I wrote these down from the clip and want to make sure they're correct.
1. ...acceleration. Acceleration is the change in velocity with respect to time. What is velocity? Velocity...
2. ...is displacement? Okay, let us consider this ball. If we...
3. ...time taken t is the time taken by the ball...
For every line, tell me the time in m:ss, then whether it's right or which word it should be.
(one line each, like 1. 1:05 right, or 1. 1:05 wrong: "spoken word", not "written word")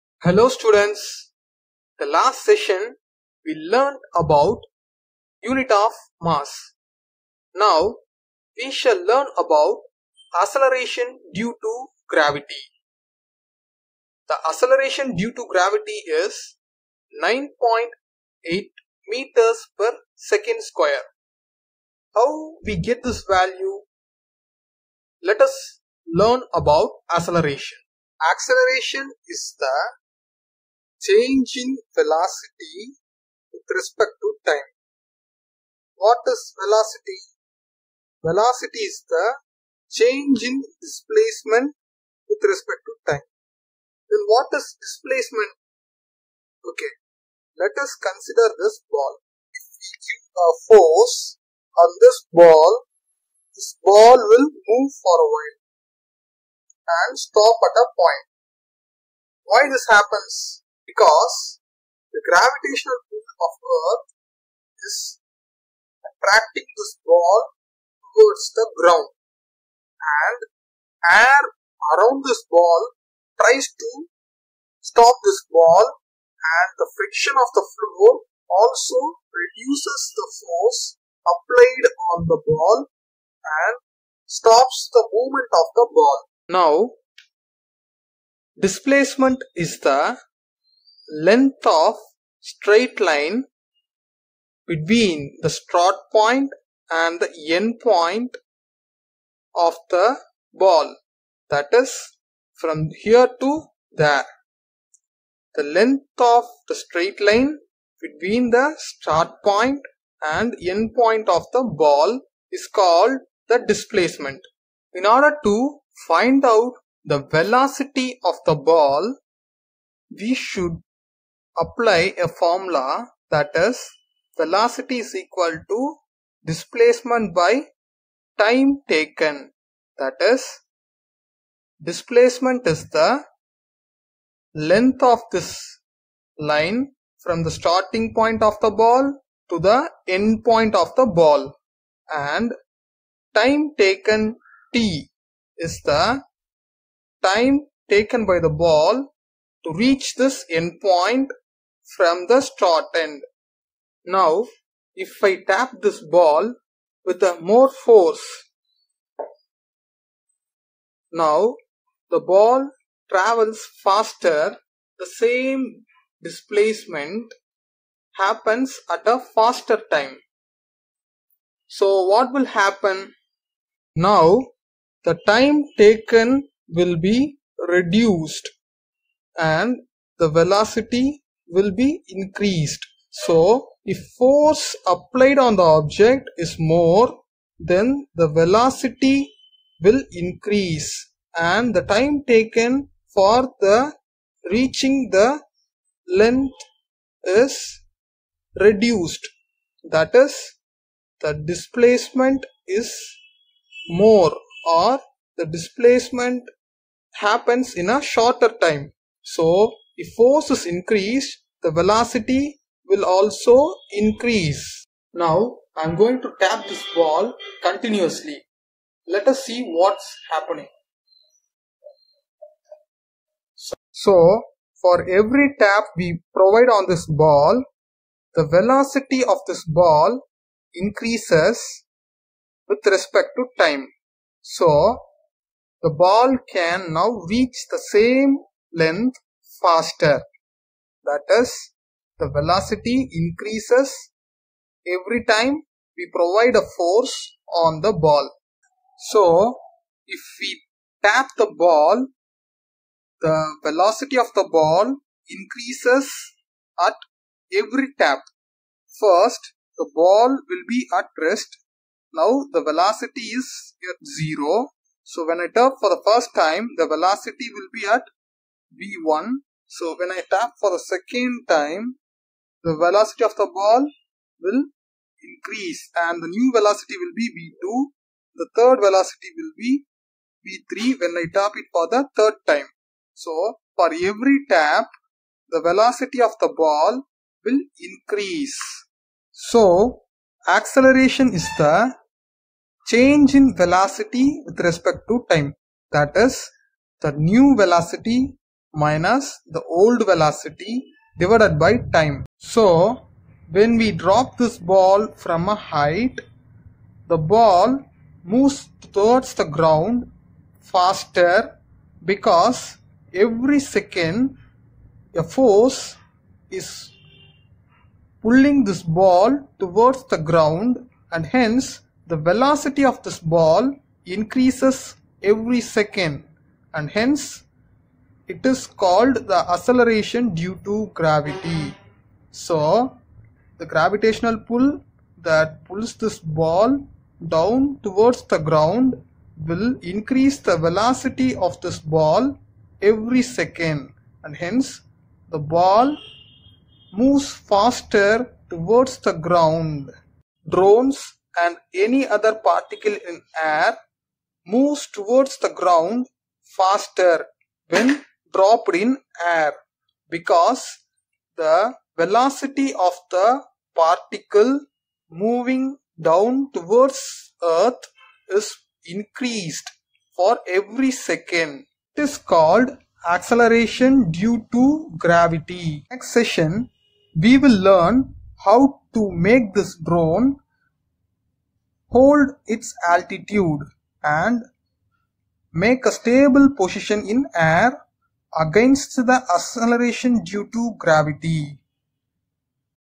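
1. 0:27 right
2. 0:44 right
3. 2:23 right.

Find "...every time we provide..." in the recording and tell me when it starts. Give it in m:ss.
4:04.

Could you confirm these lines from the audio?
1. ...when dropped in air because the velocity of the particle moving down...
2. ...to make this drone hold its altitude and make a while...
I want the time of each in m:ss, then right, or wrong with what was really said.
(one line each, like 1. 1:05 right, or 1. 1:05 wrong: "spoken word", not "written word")
1. 5:57 right
2. 6:18 wrong: "stable", not "while".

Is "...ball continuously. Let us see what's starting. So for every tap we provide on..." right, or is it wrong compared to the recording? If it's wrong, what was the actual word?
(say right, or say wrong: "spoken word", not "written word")
wrong: "happening", not "starting".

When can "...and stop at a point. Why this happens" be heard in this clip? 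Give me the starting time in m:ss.
0:57.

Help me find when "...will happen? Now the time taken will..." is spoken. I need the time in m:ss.
2:52.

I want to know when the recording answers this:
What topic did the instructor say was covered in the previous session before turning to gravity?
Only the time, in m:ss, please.
0:05.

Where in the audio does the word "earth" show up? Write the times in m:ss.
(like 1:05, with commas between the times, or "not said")
1:03, 6:07.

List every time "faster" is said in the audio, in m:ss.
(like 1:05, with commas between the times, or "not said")
2:43, 2:49, 3:59, 5:10, 5:47, 5:56.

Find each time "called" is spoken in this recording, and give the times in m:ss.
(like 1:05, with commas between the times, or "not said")
1:52, 5:28, 6:12.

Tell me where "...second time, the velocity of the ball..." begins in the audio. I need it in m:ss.
4:30.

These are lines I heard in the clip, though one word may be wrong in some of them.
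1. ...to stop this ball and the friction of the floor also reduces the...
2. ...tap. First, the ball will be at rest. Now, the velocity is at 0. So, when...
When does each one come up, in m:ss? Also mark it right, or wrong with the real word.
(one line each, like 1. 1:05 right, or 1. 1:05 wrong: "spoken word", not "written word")
1. 1:13 right
2. 4:17 right.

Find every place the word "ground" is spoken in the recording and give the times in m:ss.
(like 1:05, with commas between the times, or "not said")
1:08, 5:09, 5:20, 5:38, 5:49, 5:55.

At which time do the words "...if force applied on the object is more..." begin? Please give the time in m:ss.
3:03.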